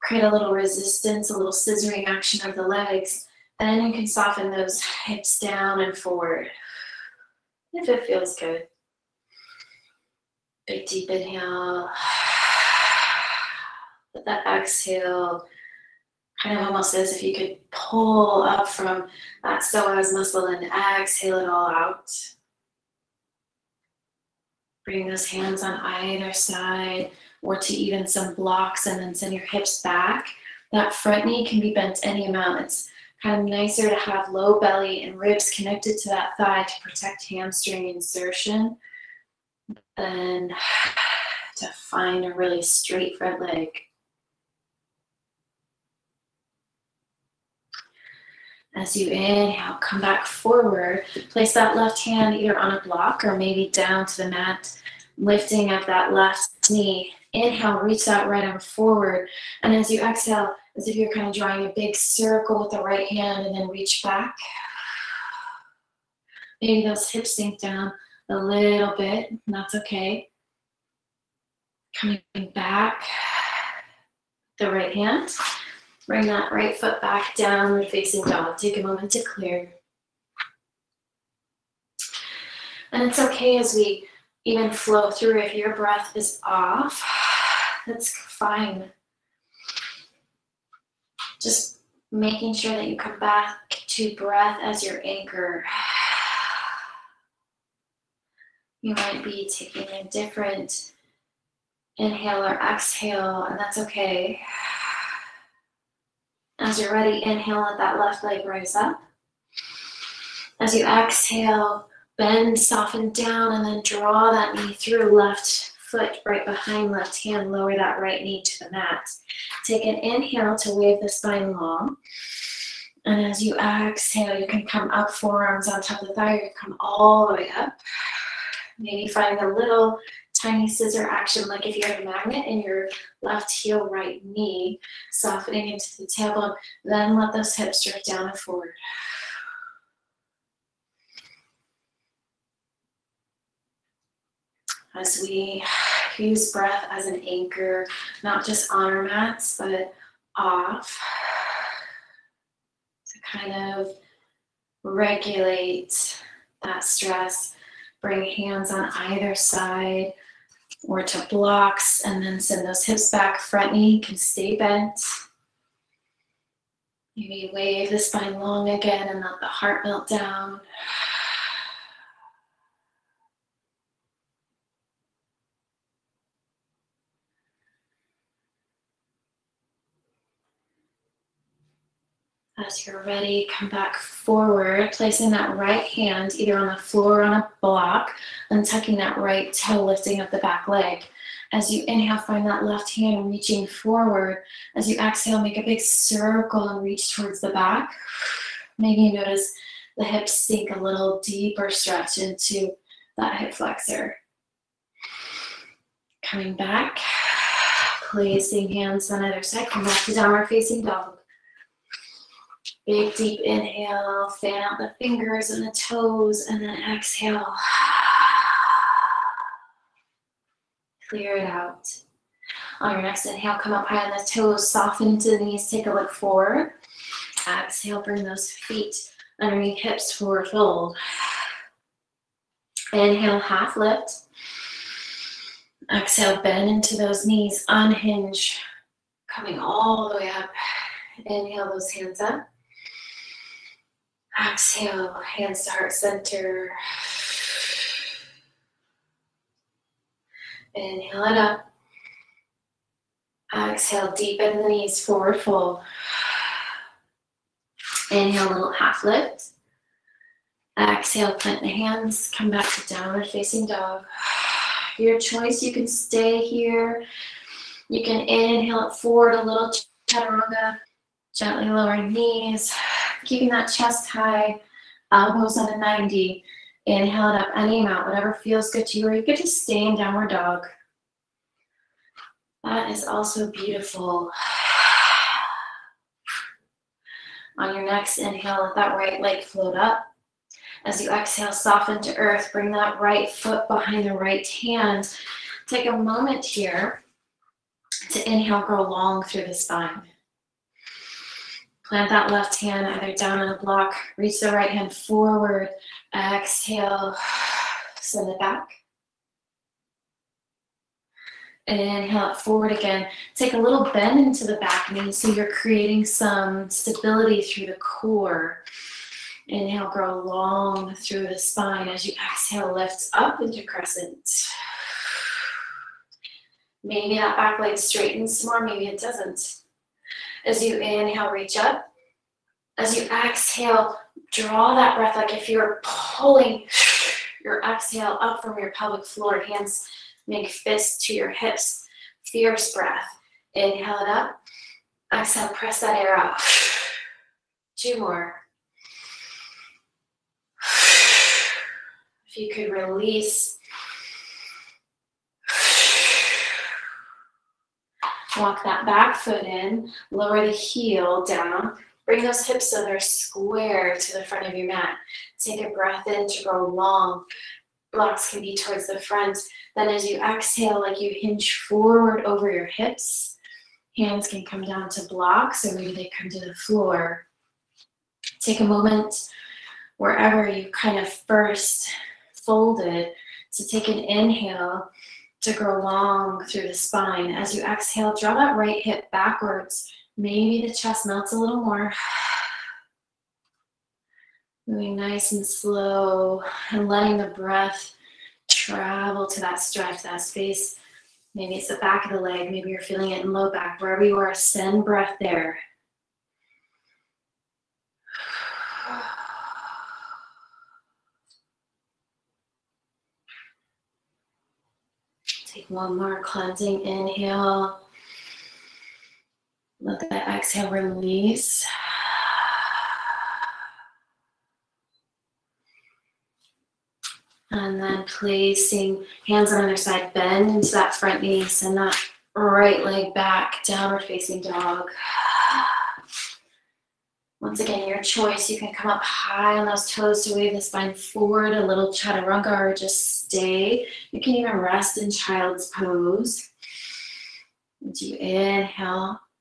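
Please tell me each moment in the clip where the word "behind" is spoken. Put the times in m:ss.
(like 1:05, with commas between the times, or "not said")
1:56, 4:53.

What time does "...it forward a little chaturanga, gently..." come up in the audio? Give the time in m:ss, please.
4:28.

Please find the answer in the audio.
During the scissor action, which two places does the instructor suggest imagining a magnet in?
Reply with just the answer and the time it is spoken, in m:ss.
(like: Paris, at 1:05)
left heel, right knee, at 2:13.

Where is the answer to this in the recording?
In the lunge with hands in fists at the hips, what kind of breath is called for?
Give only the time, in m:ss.
5:42.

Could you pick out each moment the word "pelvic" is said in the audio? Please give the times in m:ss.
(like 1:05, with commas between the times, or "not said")
5:38.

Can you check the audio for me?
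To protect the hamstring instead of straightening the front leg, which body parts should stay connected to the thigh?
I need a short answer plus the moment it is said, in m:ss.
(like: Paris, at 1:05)
low belly and ribs, at 0:34.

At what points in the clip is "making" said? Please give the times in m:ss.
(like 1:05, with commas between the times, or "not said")
1:32.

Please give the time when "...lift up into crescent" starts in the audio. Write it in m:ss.
5:22.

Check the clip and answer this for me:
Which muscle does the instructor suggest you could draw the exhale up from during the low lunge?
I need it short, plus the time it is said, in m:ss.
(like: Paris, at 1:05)
psoas, at 0:19.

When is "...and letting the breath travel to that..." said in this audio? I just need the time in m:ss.
6:36.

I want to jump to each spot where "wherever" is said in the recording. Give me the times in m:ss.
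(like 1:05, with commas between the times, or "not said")
6:19, 6:43.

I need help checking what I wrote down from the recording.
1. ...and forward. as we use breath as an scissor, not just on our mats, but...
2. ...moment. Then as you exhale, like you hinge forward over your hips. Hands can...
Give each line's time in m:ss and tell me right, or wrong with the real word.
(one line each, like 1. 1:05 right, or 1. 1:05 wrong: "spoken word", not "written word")
1. 2:18 wrong: "anchor", not "scissor"
2. 6:08 wrong: "front", not "moment".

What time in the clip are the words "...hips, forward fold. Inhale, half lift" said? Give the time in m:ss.
3:49.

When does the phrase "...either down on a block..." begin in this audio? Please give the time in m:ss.
5:02.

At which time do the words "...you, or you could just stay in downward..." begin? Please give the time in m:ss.
4:38.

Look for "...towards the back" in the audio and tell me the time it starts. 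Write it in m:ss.
3:17.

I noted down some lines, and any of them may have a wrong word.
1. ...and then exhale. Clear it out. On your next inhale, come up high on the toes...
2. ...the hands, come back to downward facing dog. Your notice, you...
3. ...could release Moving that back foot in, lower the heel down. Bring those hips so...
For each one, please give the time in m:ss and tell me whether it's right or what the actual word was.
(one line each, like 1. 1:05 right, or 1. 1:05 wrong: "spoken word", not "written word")
1. 3:36 right
2. 4:21 wrong: "choice", not "notice"
3. 5:52 wrong: "Walk", not "Moving".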